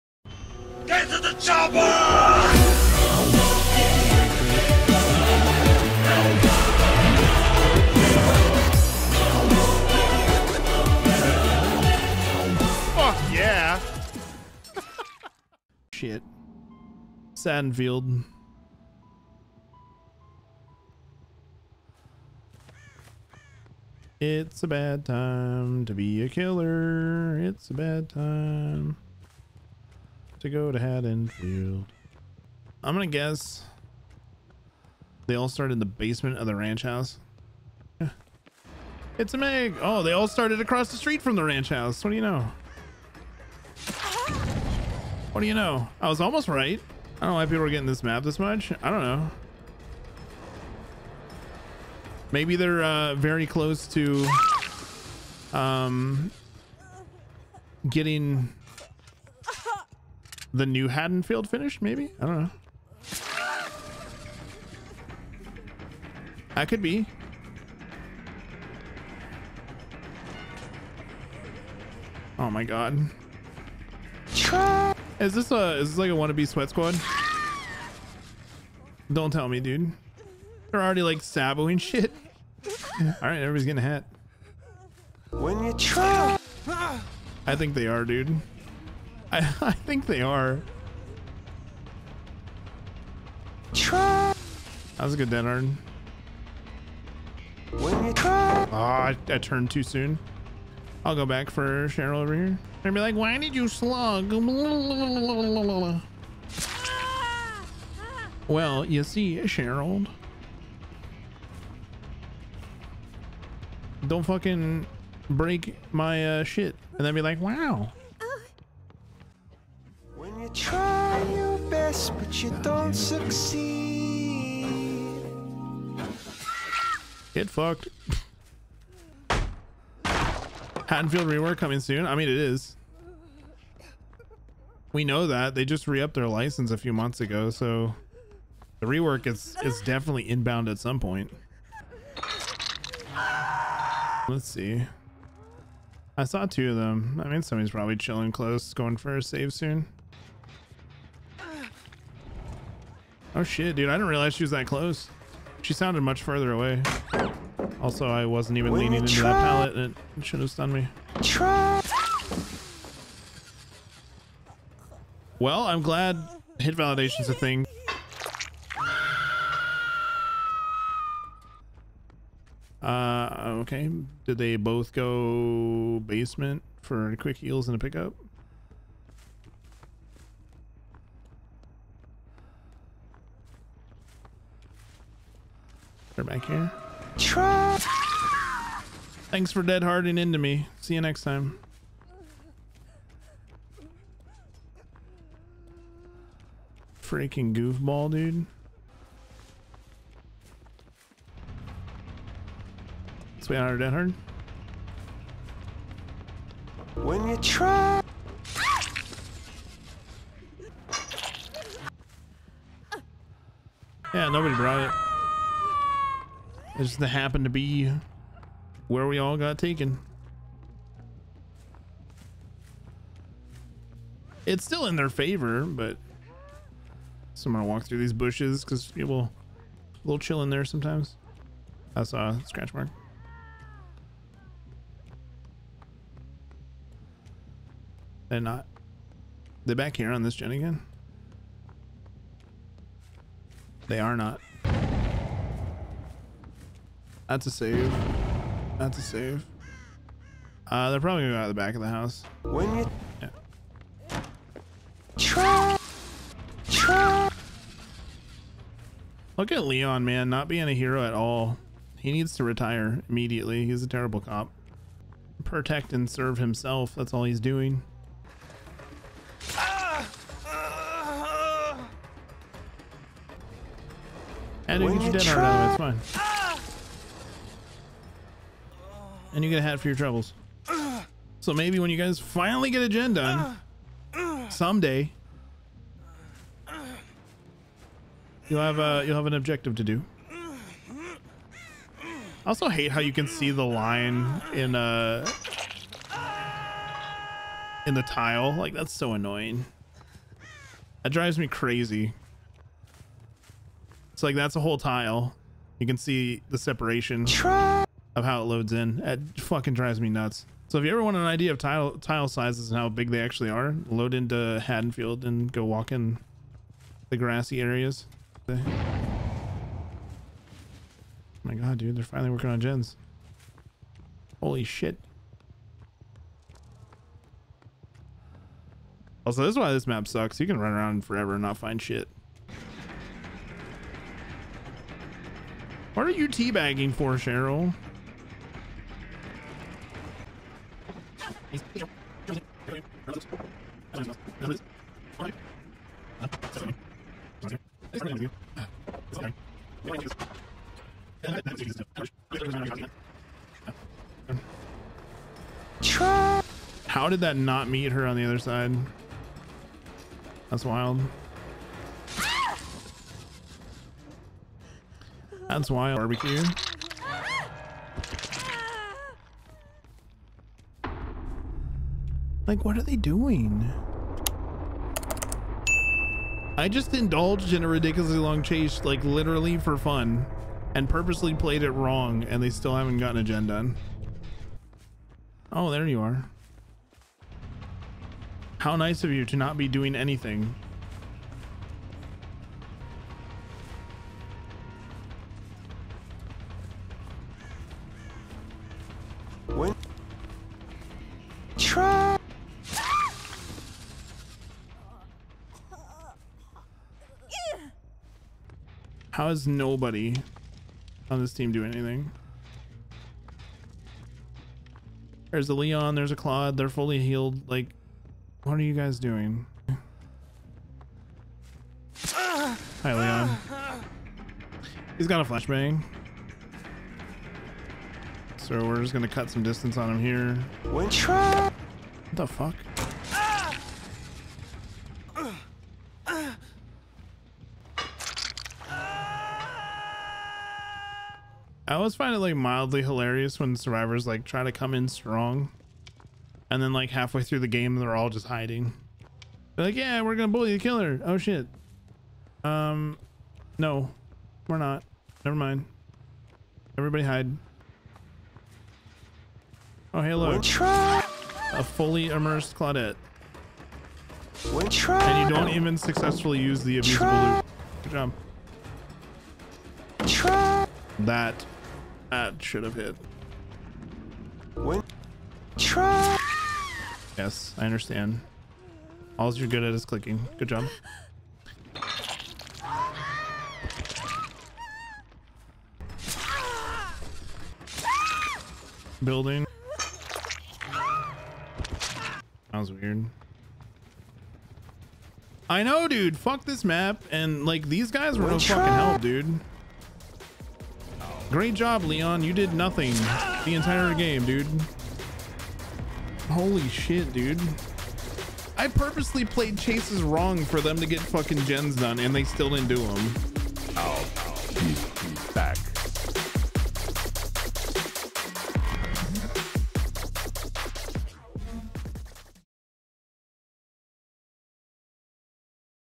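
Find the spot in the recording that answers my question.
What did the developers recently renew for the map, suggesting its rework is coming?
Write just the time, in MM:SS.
02:16.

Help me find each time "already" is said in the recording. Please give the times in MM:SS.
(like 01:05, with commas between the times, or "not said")
01:20, 04:35.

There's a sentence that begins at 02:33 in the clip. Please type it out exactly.
Oh shit, dude, I didn't realize she was that close.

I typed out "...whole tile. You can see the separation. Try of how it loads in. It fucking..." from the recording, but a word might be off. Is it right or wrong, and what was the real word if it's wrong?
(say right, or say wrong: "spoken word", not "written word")
right.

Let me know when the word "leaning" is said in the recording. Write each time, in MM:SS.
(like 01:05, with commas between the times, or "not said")
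02:38.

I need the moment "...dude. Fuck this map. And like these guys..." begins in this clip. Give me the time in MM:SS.
08:15.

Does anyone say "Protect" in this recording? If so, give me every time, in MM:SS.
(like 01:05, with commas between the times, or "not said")
04:25.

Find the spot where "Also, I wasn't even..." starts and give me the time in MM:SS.
02:37.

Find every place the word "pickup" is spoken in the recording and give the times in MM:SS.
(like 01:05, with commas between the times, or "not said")
02:57.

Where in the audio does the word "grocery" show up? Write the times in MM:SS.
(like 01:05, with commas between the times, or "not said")
not said.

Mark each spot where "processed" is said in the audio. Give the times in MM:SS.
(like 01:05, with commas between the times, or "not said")
not said.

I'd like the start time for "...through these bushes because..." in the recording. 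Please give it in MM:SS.
03:47.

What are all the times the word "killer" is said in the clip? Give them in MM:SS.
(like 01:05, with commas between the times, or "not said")
00:26, 07:30.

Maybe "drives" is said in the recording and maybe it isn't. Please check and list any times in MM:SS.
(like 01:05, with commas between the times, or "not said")
05:01, 05:09.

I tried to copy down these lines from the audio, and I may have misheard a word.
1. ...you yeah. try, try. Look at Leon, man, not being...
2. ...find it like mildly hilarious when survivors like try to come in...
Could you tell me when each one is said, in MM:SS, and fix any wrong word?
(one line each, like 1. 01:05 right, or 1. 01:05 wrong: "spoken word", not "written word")
1. 04:12 right
2. 07:21 right.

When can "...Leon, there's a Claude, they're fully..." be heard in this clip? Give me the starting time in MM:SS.
06:55.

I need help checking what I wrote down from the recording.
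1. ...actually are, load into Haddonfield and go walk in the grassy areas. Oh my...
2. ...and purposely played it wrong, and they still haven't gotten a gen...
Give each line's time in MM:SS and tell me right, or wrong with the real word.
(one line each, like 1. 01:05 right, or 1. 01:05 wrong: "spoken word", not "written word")
1. 05:13 right
2. 06:20 right.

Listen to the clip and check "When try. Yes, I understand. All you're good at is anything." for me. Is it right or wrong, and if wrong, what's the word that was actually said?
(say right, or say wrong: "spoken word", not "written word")
wrong: "clicking", not "anything".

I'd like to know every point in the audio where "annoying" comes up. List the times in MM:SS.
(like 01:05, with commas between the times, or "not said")
04:59.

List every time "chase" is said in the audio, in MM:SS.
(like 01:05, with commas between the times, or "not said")
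06:18, 08:29.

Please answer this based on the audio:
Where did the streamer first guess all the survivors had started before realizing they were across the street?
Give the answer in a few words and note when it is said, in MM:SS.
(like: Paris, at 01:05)
basement of the ranch house, at 00:35.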